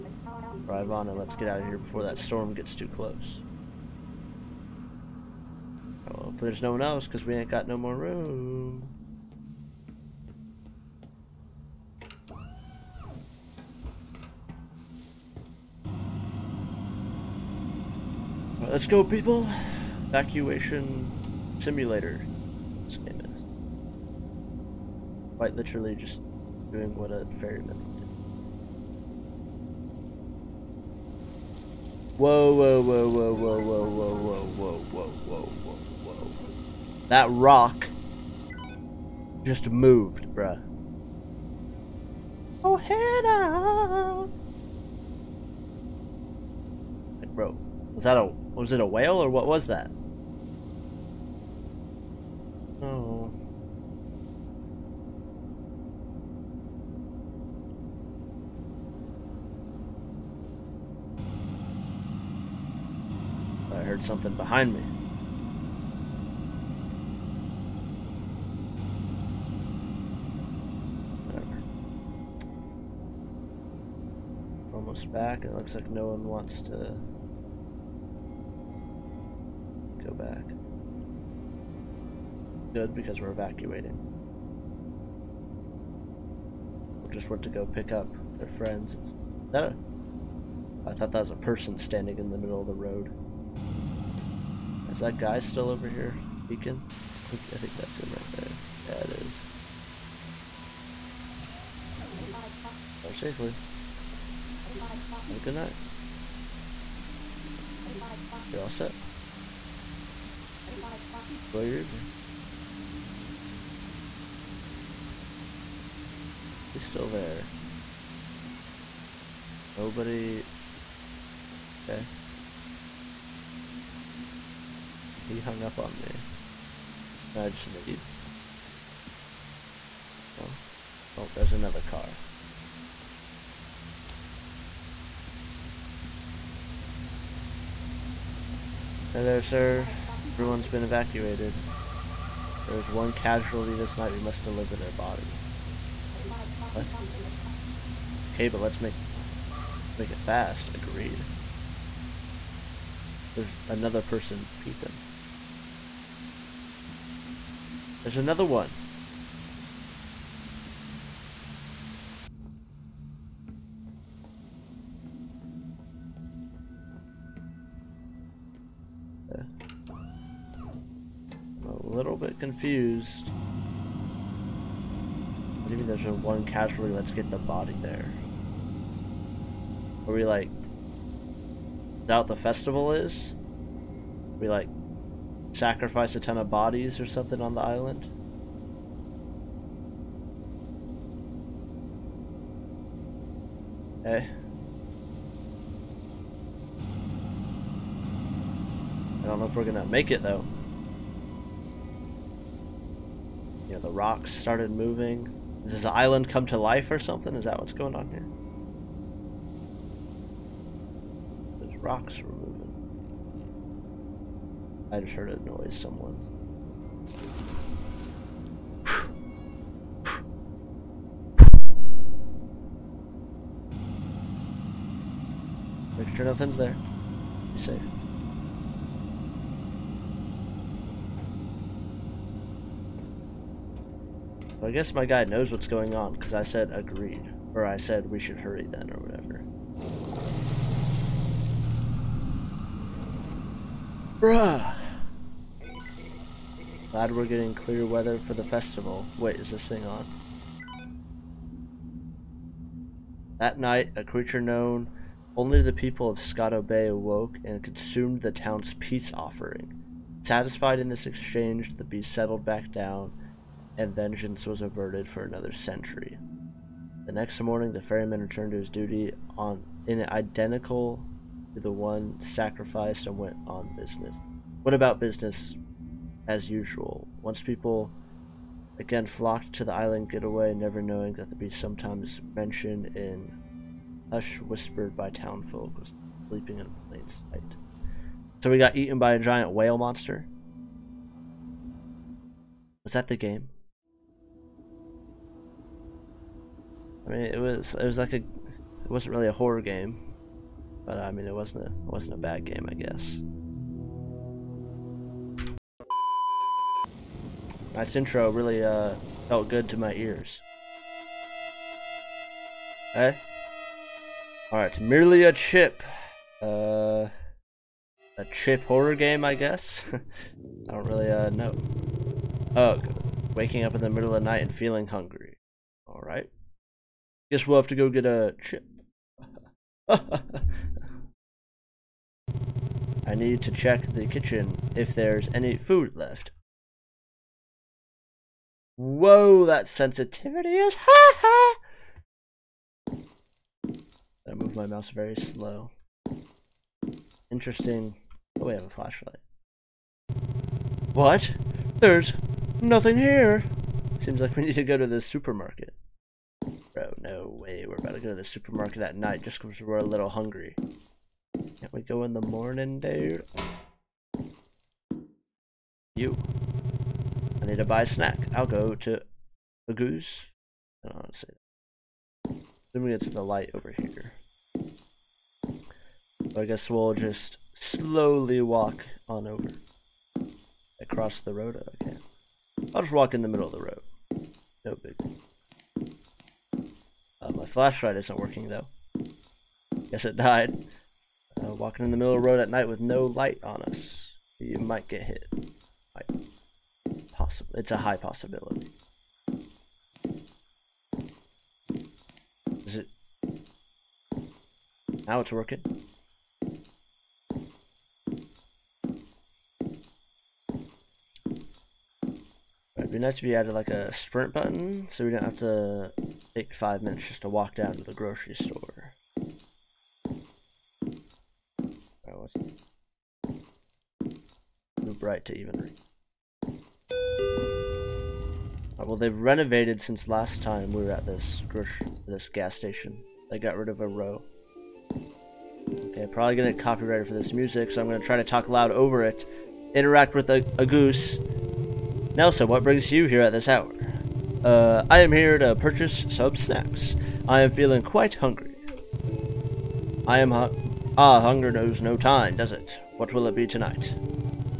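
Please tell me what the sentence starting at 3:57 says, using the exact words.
Or I said we should hurry then or whatever.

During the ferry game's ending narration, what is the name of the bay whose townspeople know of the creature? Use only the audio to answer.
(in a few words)
Scotto Bay.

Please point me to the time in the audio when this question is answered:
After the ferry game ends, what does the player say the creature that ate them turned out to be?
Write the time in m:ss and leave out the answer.
4:49.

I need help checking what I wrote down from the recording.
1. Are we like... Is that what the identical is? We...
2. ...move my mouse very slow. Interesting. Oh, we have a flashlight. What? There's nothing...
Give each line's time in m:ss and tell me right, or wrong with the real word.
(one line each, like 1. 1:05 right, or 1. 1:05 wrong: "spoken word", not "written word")
1. 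3:00 wrong: "festival", not "identical"
2. 5:44 right.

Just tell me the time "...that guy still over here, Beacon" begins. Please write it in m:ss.
1:35.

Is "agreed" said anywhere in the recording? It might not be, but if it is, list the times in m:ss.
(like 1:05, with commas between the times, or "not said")
2:30, 3:56.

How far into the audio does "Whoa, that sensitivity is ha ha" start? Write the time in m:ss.
5:38.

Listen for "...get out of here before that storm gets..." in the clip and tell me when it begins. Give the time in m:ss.
0:01.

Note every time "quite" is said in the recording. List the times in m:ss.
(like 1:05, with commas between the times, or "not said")
0:25, 7:27.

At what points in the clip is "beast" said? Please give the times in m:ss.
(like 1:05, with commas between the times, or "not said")
4:21, 4:41.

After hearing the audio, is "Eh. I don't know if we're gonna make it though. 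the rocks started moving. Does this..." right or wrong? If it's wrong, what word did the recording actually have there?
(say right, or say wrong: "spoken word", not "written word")
right.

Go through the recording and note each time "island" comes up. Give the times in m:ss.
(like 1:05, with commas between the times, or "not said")
3:07, 3:25, 4:39.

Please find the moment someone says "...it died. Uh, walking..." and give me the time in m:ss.
6:30.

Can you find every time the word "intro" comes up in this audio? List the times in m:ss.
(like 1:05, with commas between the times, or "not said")
5:07.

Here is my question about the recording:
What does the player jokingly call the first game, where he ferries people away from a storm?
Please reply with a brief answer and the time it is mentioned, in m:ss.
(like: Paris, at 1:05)
Evacuation simulator, at 0:20.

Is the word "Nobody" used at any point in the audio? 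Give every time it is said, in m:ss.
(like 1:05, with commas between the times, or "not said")
1:59.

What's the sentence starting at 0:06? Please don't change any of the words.
Well, if there's no one else, because we ain't got no more room.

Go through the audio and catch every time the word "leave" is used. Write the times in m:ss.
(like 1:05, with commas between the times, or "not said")
2:07.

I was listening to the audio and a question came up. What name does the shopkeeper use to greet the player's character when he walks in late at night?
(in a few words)
Nelson.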